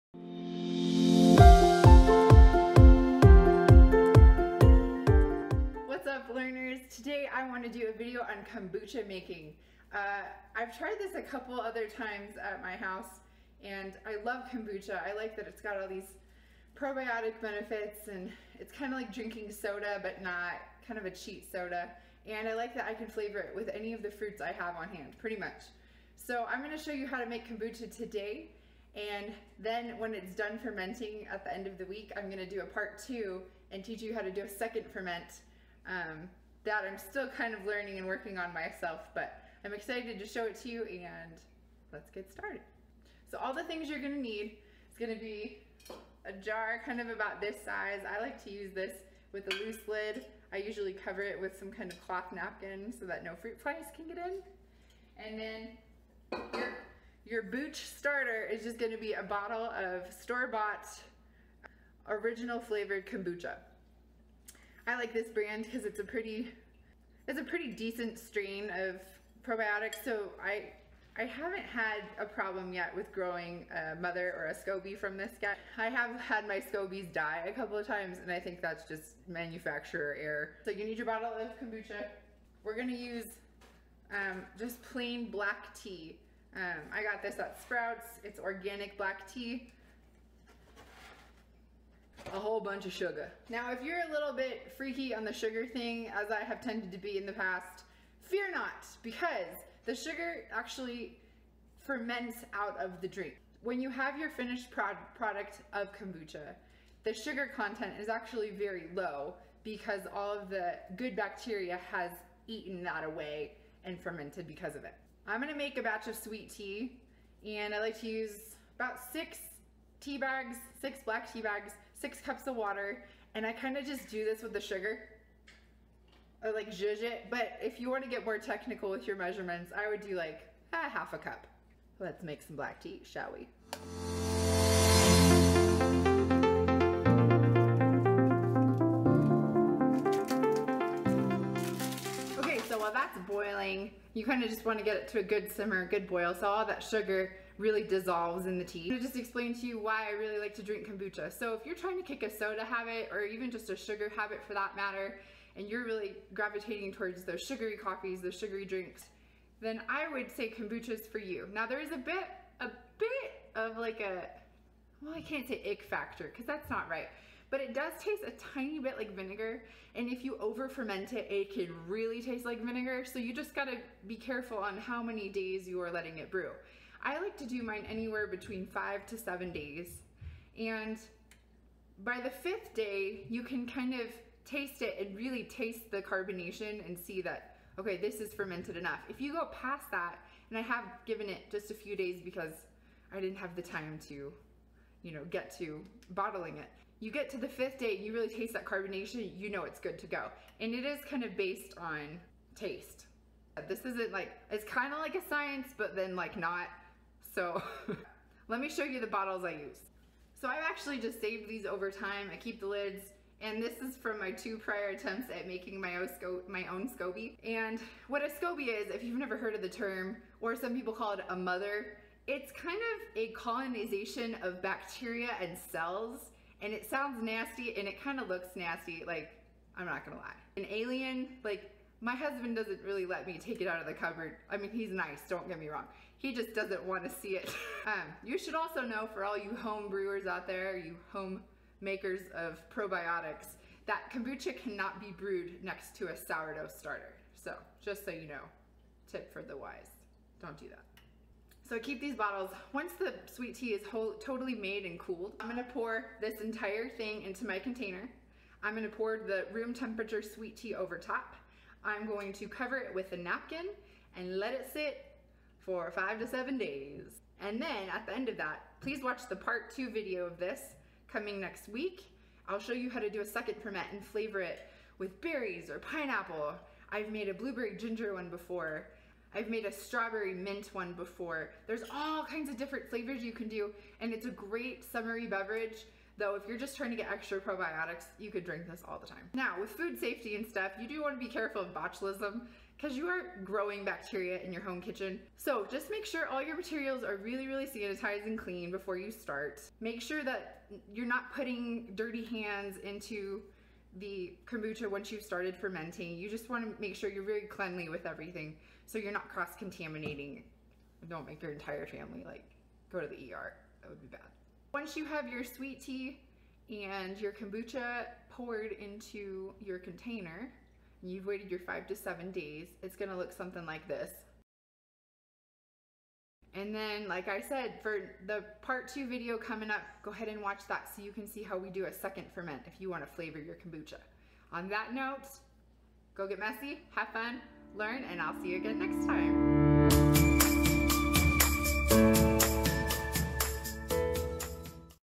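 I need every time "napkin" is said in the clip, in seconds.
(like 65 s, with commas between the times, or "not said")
52 s, 263 s.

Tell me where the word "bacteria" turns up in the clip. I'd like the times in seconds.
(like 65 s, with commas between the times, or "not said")
111 s, 224 s, 293 s.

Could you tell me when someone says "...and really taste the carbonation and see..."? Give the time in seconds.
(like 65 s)
184 s.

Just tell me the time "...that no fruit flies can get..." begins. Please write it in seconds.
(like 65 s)
53 s.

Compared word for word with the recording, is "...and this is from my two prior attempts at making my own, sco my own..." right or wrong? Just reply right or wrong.
right.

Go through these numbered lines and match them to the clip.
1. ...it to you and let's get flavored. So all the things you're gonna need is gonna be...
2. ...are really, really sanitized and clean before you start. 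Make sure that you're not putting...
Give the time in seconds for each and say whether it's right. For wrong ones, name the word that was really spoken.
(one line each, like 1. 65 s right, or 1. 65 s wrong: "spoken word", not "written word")
1. 40 s wrong: "started", not "flavored"
2. 297 s right.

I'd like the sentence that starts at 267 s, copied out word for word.
And then at the end of that, please watch the part two video of this coming next week.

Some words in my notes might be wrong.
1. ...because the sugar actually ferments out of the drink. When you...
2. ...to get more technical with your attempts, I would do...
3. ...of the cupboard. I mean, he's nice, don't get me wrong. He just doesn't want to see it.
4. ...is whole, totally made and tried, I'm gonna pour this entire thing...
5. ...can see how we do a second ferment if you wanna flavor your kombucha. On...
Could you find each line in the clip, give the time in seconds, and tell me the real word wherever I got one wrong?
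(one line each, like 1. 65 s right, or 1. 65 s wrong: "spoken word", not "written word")
1. 99 s right
2. 128 s wrong: "measurements", not "attempts"
3. 233 s right
4. 253 s wrong: "cooled", not "tried"
5. 331 s right.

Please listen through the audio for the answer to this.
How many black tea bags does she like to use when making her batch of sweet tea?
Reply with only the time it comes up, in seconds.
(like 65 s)
119 s.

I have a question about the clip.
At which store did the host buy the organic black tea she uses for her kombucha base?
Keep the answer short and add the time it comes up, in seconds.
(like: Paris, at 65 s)
Sprouts, at 87 s.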